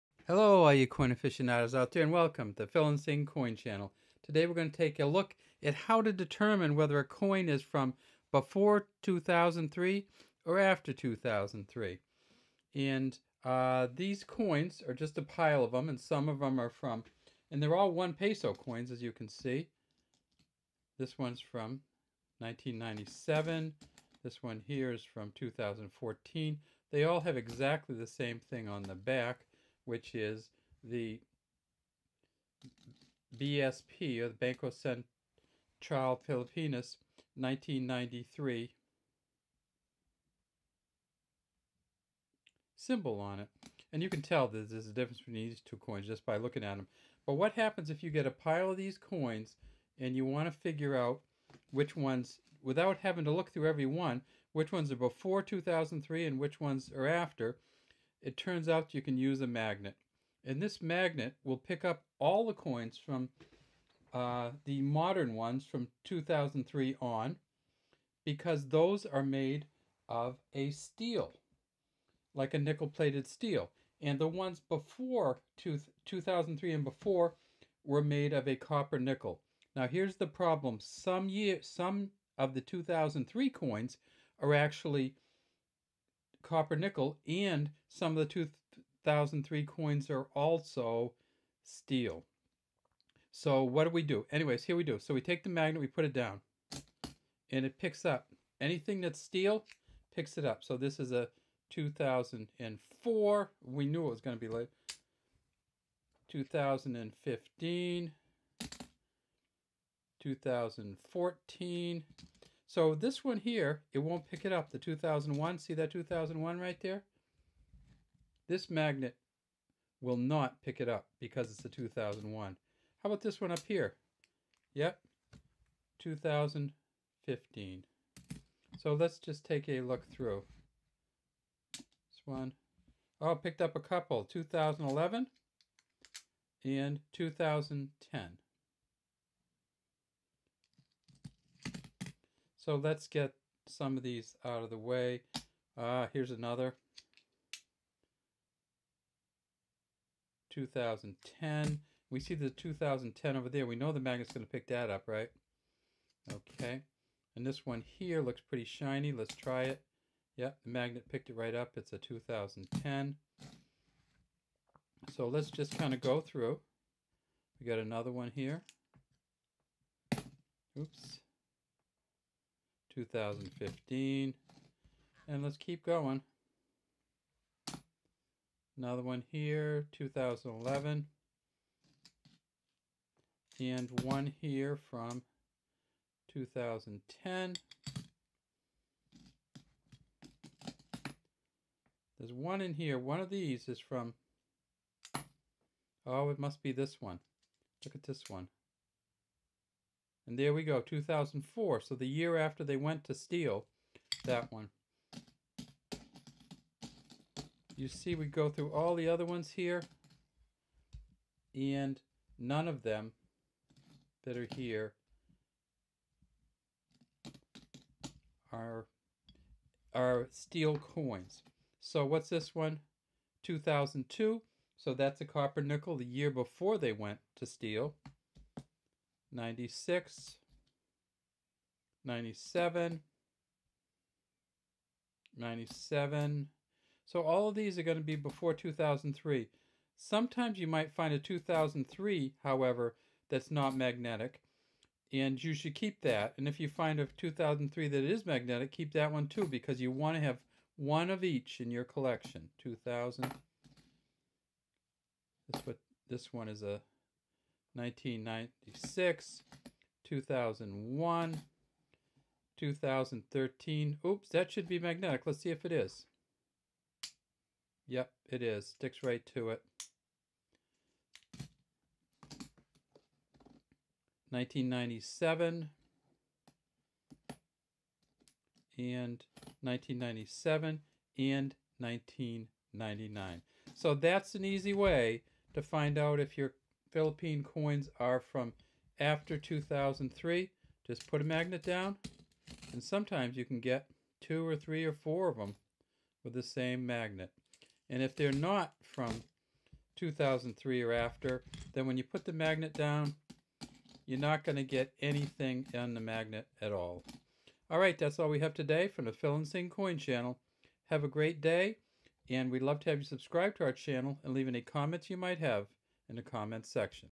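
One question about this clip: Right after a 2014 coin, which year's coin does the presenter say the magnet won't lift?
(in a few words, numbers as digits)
2001.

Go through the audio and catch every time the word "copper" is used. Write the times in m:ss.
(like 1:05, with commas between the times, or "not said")
1:18, 1:26, 3:45.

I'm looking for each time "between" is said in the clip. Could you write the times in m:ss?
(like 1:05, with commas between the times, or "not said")
0:45.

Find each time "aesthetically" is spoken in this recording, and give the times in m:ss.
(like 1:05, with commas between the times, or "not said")
not said.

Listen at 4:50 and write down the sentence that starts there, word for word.
Just put a magnet down, and sometimes you can get two or three or four of them with the same magnet.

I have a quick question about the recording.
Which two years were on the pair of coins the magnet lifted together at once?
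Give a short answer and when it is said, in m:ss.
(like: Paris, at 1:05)
2011 and 2010, at 2:14.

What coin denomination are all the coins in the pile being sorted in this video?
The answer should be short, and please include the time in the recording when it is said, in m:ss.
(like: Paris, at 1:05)
one peso, at 0:17.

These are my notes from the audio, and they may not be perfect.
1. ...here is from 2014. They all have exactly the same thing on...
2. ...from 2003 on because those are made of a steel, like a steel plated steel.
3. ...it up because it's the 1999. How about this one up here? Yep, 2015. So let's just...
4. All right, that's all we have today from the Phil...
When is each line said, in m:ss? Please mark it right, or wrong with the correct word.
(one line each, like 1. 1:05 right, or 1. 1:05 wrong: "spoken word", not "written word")
1. 0:24 right
2. 1:05 wrong: "nickel", not "steel"
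3. 2:00 wrong: "2001", not "1999"
4. 5:07 right.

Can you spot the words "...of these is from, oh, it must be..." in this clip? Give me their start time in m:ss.
3:13.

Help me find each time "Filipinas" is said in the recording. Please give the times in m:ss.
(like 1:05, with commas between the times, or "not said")
0:36.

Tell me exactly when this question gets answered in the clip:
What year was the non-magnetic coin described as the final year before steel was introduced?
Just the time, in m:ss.
3:43.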